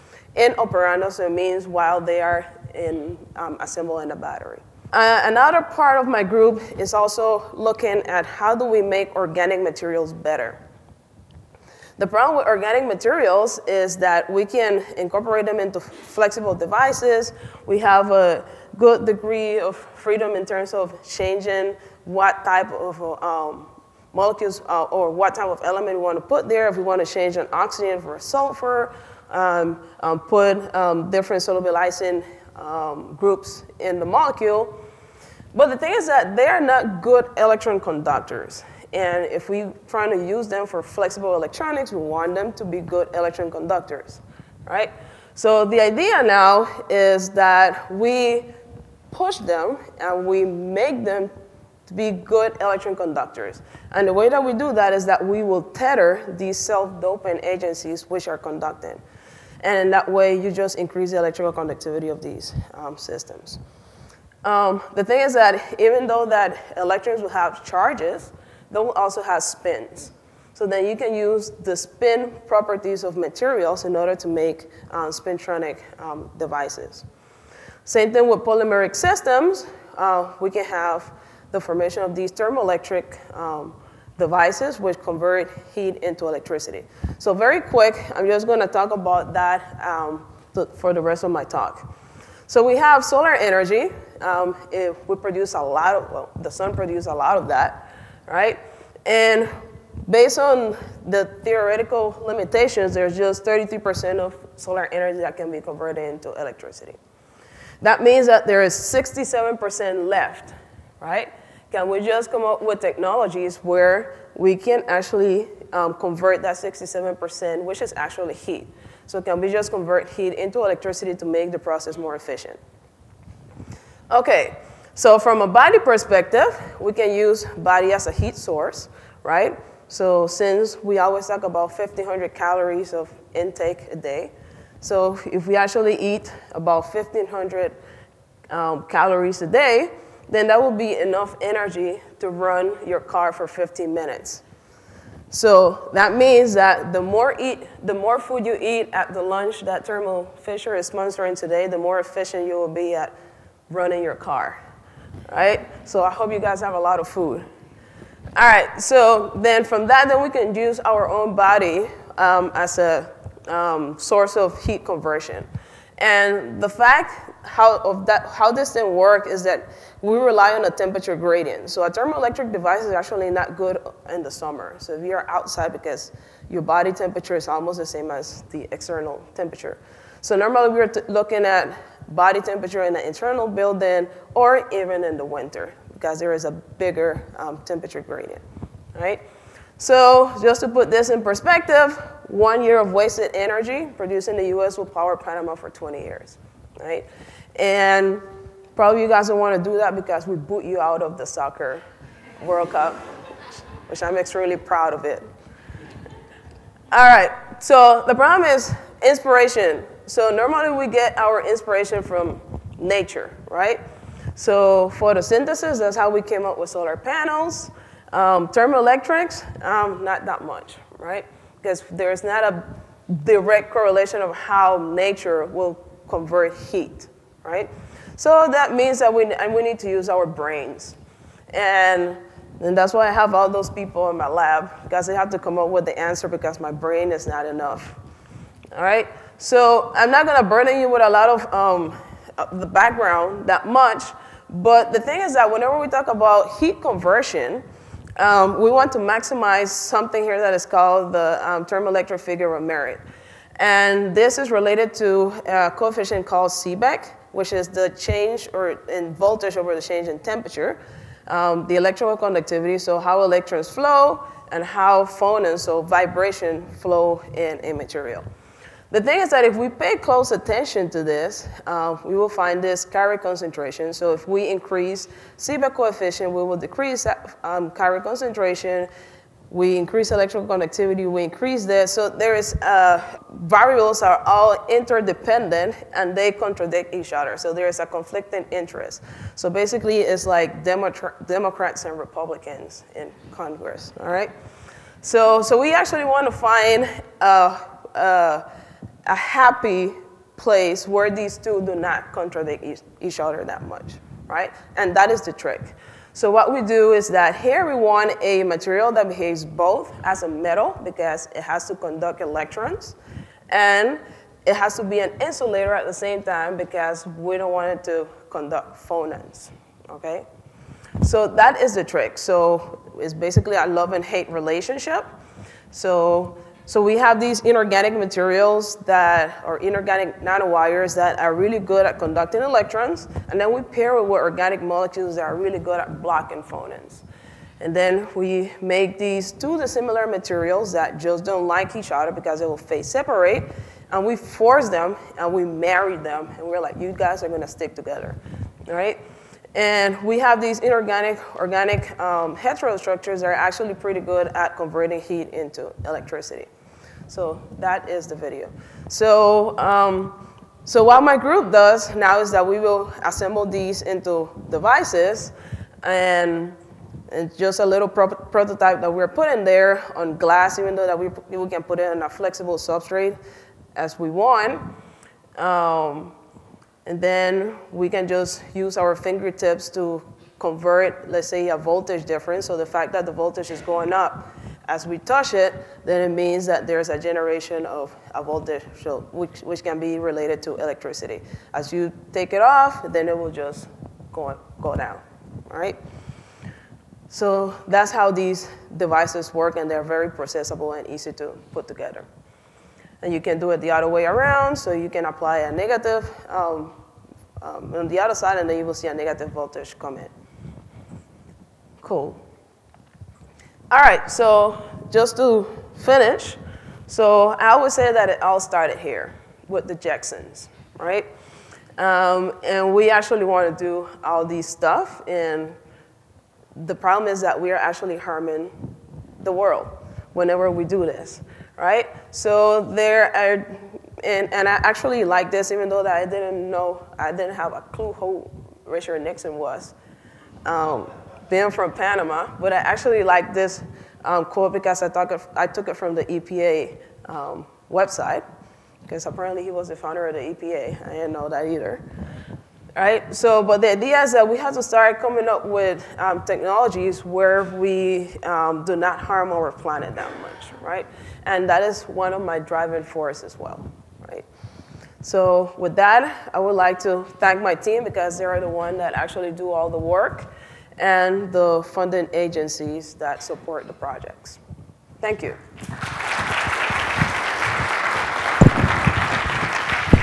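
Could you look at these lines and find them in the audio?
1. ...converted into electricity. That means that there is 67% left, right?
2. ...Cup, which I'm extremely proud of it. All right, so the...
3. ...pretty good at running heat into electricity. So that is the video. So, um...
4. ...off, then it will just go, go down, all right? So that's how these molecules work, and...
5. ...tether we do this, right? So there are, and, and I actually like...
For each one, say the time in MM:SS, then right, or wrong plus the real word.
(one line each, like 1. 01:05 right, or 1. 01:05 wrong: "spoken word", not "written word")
1. 01:45 right
2. 03:22 right
3. 05:53 wrong: "converting", not "running"
4. 06:32 wrong: "devices", not "molecules"
5. 07:10 wrong: "whenever", not "tether".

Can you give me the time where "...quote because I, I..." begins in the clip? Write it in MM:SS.
07:24.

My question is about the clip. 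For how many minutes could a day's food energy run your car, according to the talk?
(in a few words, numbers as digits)
15 minutes.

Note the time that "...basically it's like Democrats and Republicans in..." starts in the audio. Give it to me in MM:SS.
04:49.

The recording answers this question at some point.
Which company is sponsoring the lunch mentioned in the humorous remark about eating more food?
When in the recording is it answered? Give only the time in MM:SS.
02:29.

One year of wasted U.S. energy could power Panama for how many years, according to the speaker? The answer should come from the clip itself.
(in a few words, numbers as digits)
20.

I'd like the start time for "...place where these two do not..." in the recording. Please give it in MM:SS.
05:00.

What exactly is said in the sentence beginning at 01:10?
So then you can use the spin properties of materials in order to make um, spintronic um, devices.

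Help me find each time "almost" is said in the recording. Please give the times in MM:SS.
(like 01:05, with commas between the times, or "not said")
02:57.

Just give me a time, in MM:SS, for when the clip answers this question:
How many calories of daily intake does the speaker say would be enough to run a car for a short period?
02:11.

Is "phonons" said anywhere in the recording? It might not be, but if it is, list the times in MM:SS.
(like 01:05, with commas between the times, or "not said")
04:25, 05:18, 05:36.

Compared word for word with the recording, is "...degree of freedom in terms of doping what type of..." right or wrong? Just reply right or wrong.
wrong.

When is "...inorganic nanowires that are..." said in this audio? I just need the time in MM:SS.
05:29.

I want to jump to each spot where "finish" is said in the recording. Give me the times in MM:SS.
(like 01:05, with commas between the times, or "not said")
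06:55.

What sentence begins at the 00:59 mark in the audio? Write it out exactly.
And that way, you just increase the electrical conductivity of these um, systems.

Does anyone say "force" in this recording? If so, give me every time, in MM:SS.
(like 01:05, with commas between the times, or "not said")
05:44, 07:42.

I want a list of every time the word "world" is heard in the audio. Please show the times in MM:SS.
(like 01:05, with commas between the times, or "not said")
03:22, 07:09.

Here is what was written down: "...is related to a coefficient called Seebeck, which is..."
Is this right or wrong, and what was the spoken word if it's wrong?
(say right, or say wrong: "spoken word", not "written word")
right.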